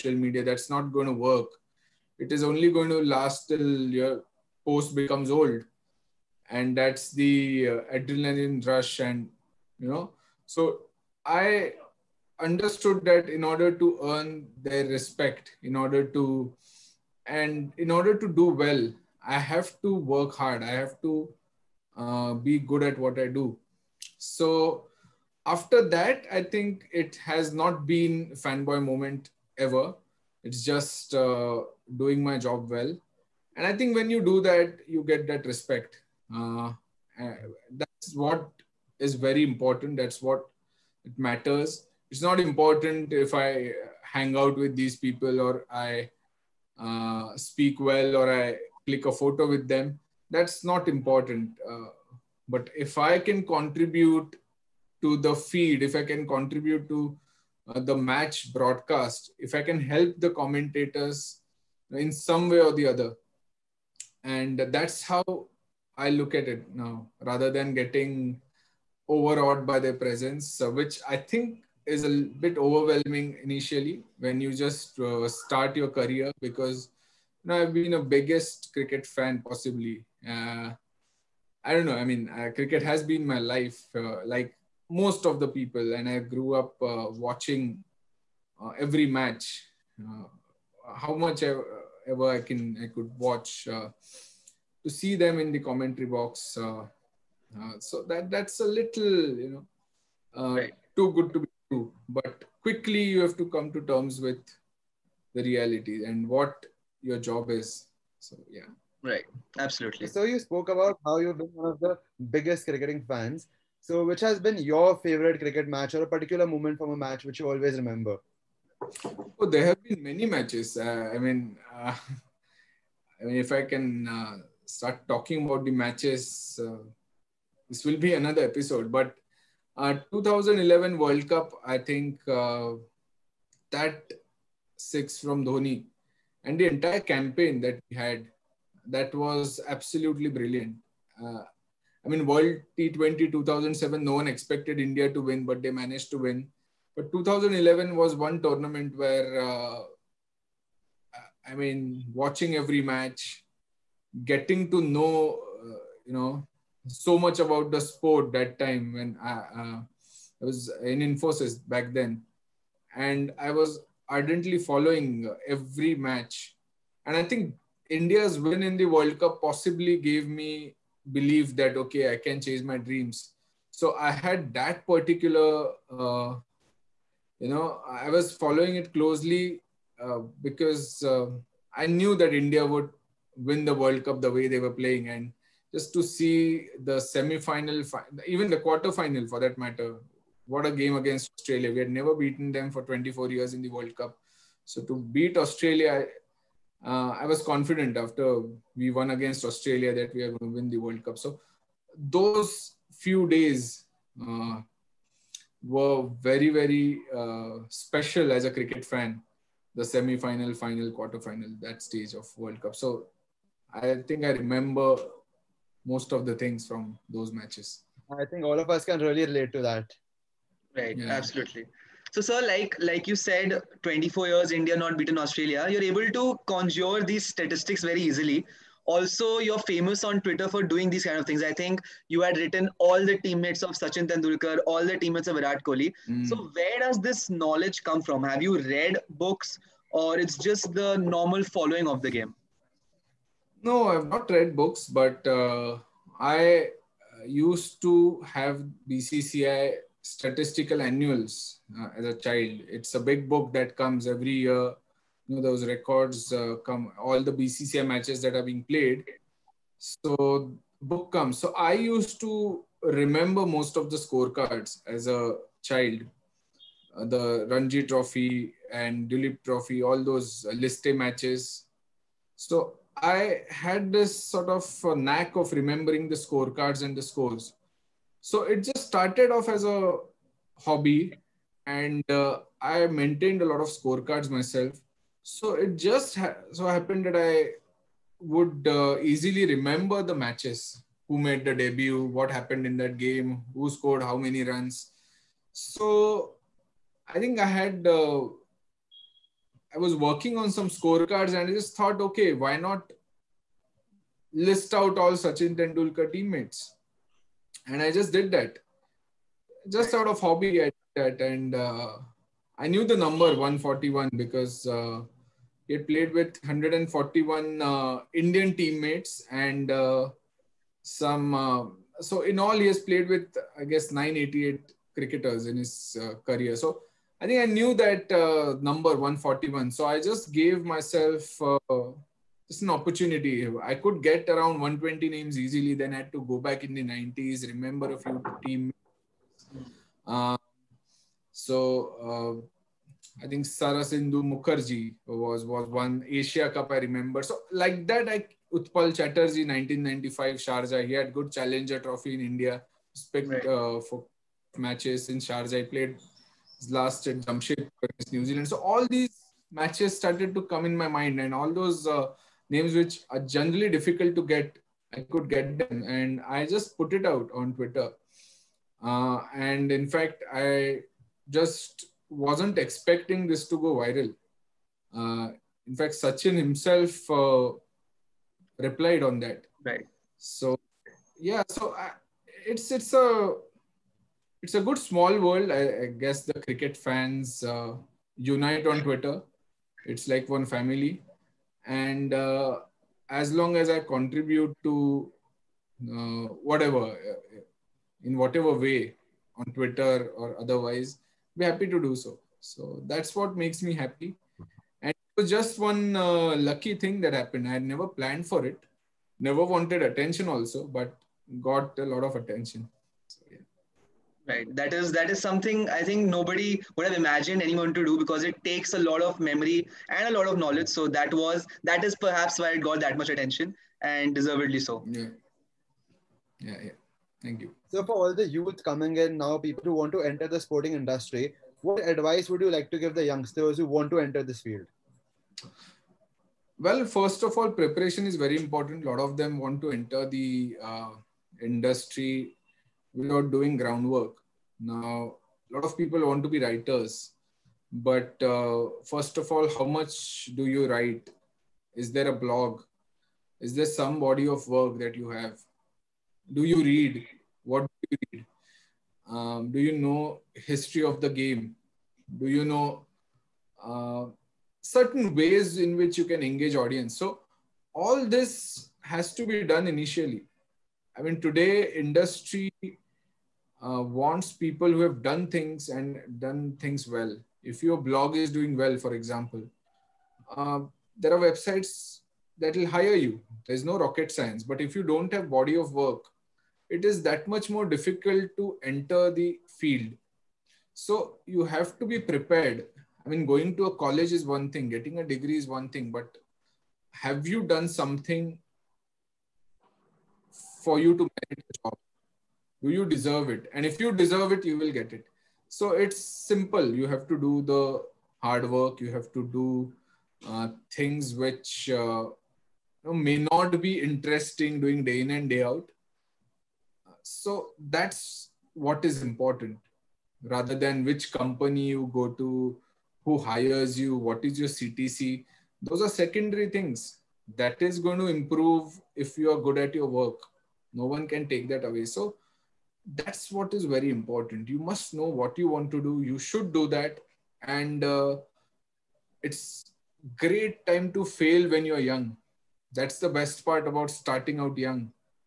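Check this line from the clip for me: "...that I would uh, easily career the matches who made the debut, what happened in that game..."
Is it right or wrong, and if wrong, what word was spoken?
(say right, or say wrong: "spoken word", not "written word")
wrong: "remember", not "career".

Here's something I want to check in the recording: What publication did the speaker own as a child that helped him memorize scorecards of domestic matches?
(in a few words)
BCCI statistical annuals.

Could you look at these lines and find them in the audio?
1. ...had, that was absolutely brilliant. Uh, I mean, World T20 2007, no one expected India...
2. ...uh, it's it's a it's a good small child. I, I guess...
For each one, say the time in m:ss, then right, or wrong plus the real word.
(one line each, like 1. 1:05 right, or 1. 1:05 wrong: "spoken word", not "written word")
1. 2:17 right
2. 6:21 wrong: "world", not "child".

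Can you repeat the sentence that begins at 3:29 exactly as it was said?
The semi-final, final, quarter-final, that stage of World Cup.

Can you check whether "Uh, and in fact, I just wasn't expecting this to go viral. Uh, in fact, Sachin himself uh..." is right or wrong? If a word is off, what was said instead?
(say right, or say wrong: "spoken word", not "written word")
right.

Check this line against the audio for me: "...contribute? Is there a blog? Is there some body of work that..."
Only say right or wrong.
wrong.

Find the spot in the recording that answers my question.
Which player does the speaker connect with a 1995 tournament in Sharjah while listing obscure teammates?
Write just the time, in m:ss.
5:48.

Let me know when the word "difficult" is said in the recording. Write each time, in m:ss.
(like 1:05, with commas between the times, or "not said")
6:03, 8:07.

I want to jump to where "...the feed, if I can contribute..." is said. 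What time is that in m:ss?
0:55.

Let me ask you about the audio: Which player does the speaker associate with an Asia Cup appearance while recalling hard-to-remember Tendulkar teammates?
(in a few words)
Saradindu Mukherjee.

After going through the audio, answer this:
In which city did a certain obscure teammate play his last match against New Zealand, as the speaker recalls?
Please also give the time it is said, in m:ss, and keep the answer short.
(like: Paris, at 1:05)
Jamshedpur, at 5:57.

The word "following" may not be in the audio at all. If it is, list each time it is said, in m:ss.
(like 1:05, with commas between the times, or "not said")
2:44, 2:58, 4:01.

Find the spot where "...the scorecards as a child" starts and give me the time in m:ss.
4:23.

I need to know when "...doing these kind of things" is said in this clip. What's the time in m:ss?
3:50.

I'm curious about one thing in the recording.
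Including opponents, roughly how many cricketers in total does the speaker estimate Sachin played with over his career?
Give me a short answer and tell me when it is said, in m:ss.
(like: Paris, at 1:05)
988, at 5:23.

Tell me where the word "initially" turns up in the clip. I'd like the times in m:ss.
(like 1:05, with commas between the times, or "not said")
1:13, 7:49.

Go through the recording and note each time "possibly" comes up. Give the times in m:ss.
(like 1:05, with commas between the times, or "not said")
1:19, 2:49.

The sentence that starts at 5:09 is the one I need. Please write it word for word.
Just out of hobby, I did that.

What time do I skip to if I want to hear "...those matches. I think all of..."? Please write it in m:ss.
3:37.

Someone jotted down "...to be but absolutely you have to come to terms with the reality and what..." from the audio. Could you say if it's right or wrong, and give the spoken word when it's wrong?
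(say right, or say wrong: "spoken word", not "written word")
wrong: "quickly", not "absolutely".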